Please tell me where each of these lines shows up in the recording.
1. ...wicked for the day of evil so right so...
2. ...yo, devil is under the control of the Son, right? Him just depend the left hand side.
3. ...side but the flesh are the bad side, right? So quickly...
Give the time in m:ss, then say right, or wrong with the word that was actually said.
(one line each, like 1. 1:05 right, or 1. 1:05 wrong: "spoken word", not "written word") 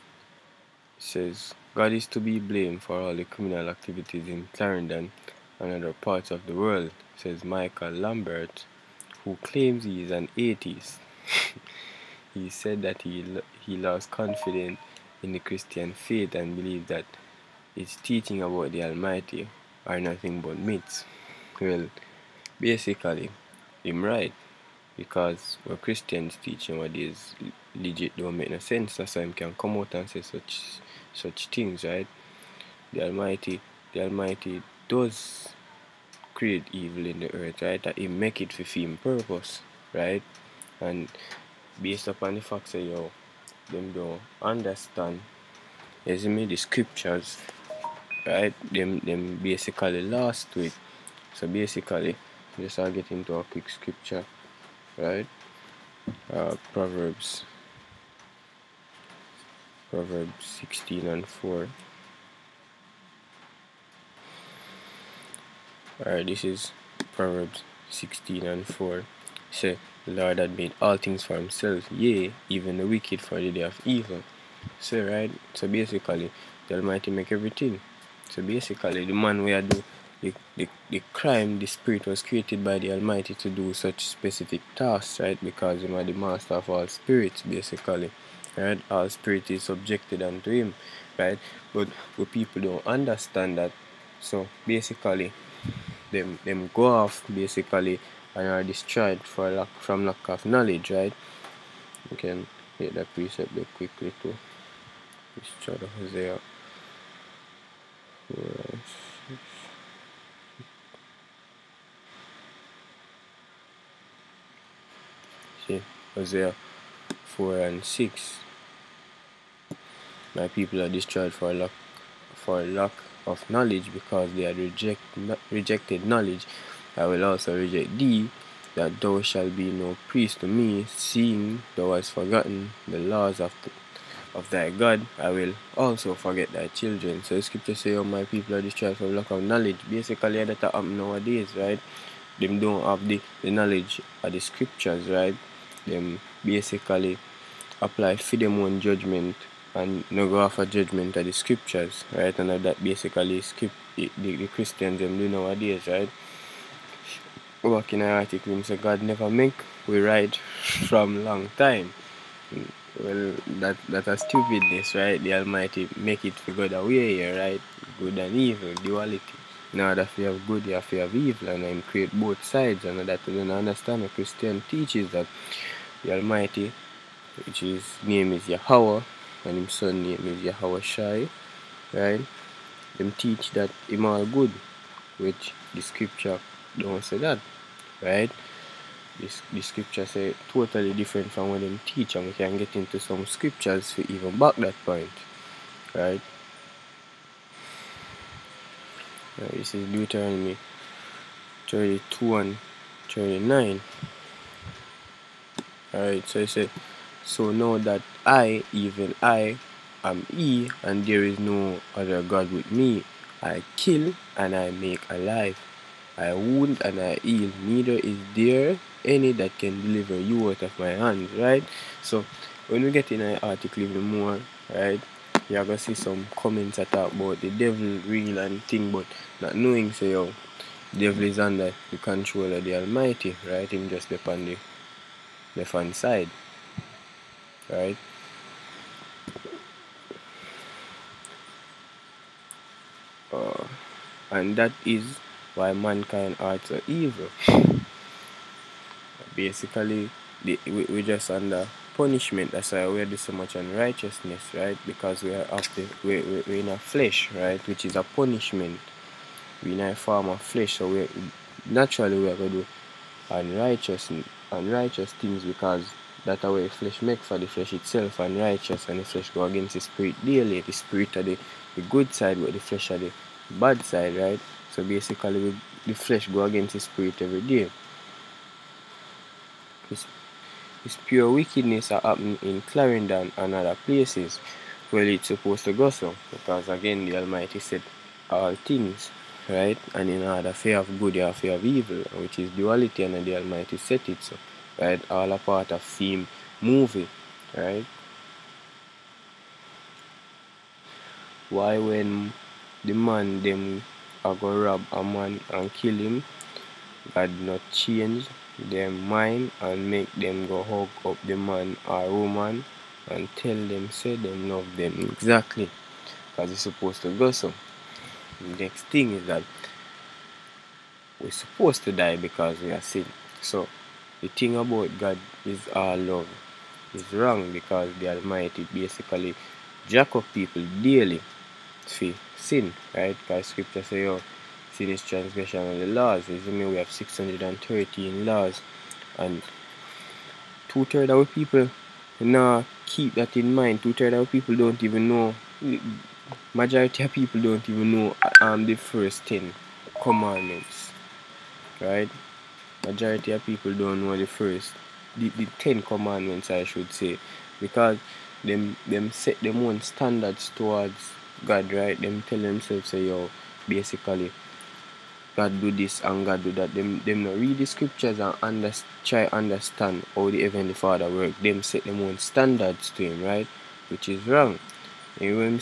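1. 1:12 right
2. 3:50 wrong: "Almighty", not "Son"
3. 4:32 wrong: "basically", not "quickly".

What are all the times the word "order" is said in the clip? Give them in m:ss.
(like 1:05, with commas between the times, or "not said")
2:49, 4:50.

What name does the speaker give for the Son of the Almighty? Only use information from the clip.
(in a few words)
Yahweh Shai.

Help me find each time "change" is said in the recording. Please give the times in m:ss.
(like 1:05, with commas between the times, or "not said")
5:07.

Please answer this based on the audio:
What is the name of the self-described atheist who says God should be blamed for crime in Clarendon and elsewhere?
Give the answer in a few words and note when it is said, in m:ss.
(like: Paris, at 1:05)
Michael Lambert, at 0:07.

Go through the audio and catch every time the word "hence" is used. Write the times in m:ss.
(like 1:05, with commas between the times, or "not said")
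not said.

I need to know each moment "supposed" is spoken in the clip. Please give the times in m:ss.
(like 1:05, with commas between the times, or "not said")
4:45, 5:16, 5:21.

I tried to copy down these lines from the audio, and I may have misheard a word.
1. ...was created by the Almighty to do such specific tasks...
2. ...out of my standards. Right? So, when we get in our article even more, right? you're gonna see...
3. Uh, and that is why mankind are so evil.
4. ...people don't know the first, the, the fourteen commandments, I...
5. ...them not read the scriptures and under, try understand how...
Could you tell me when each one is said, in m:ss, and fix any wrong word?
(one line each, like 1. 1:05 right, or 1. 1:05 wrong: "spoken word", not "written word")
1. 1:22 right
2. 3:40 wrong: "hands", not "standards"
3. 4:03 right
4. 5:53 wrong: "ten", not "fourteen"
5. 6:07 right.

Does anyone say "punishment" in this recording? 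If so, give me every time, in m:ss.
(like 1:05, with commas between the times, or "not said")
4:11, 4:18.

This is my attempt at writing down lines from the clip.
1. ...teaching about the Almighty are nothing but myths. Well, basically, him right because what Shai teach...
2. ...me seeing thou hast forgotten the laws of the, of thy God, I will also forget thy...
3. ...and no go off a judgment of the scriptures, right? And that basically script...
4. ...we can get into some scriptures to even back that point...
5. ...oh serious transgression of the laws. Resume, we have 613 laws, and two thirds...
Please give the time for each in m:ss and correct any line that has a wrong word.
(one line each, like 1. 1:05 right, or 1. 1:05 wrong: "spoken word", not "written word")
1. 0:17 wrong: "Christians", not "Shai"
2. 2:10 right
3. 2:29 right
4. 3:12 right
5. 5:34 right.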